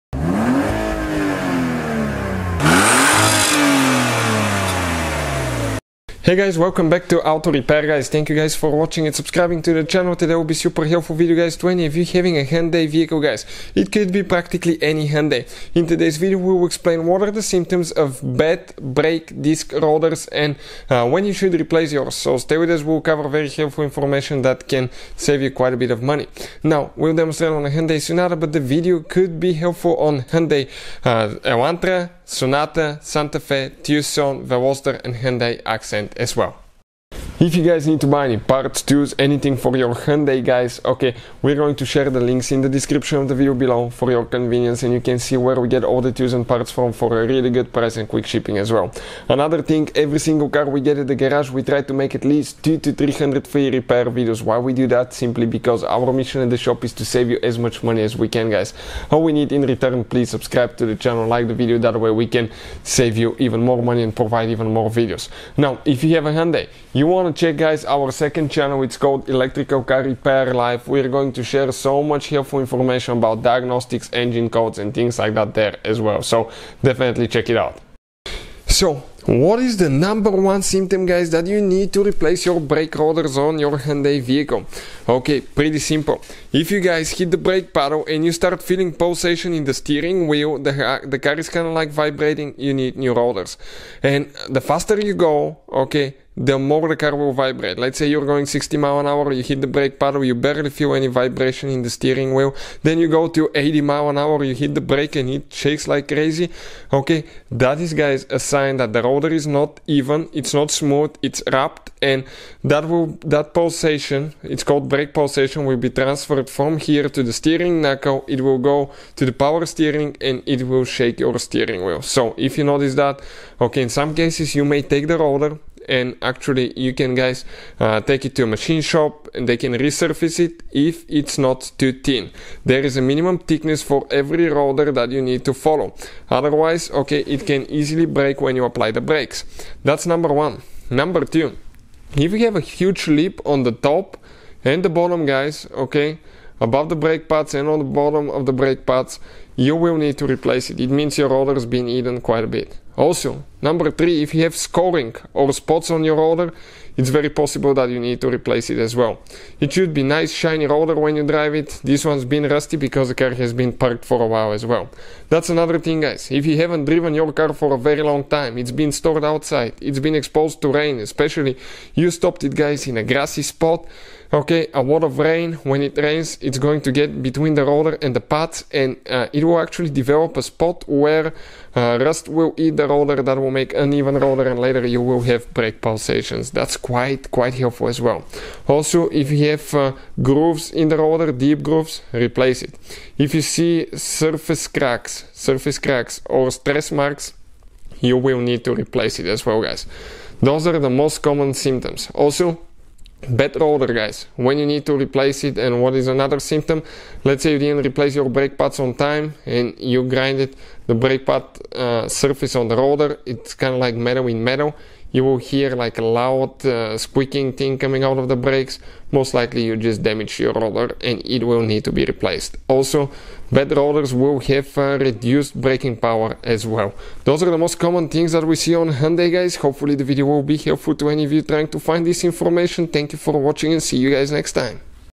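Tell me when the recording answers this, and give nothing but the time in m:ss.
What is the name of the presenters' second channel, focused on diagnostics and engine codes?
1:09.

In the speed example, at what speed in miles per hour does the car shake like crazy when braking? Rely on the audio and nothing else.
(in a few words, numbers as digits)
80.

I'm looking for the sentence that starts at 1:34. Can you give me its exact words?
And the faster you go, okay, the more the car will vibrate.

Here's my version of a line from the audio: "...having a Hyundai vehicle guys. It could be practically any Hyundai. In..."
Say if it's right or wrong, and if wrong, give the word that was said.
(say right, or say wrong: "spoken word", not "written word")
right.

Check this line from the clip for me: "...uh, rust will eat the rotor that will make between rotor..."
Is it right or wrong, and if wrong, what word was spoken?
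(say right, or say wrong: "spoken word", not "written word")
wrong: "uneven", not "between".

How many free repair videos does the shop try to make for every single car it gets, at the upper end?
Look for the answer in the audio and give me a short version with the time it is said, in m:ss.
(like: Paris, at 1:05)
300, at 0:52.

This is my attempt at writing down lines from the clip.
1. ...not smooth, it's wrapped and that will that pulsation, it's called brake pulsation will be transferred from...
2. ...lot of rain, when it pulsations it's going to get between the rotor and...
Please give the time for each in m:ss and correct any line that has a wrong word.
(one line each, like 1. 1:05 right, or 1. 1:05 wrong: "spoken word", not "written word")
1. 1:50 right
2. 2:54 wrong: "rains", not "pulsations".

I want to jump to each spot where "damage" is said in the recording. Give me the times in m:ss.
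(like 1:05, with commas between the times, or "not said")
3:40.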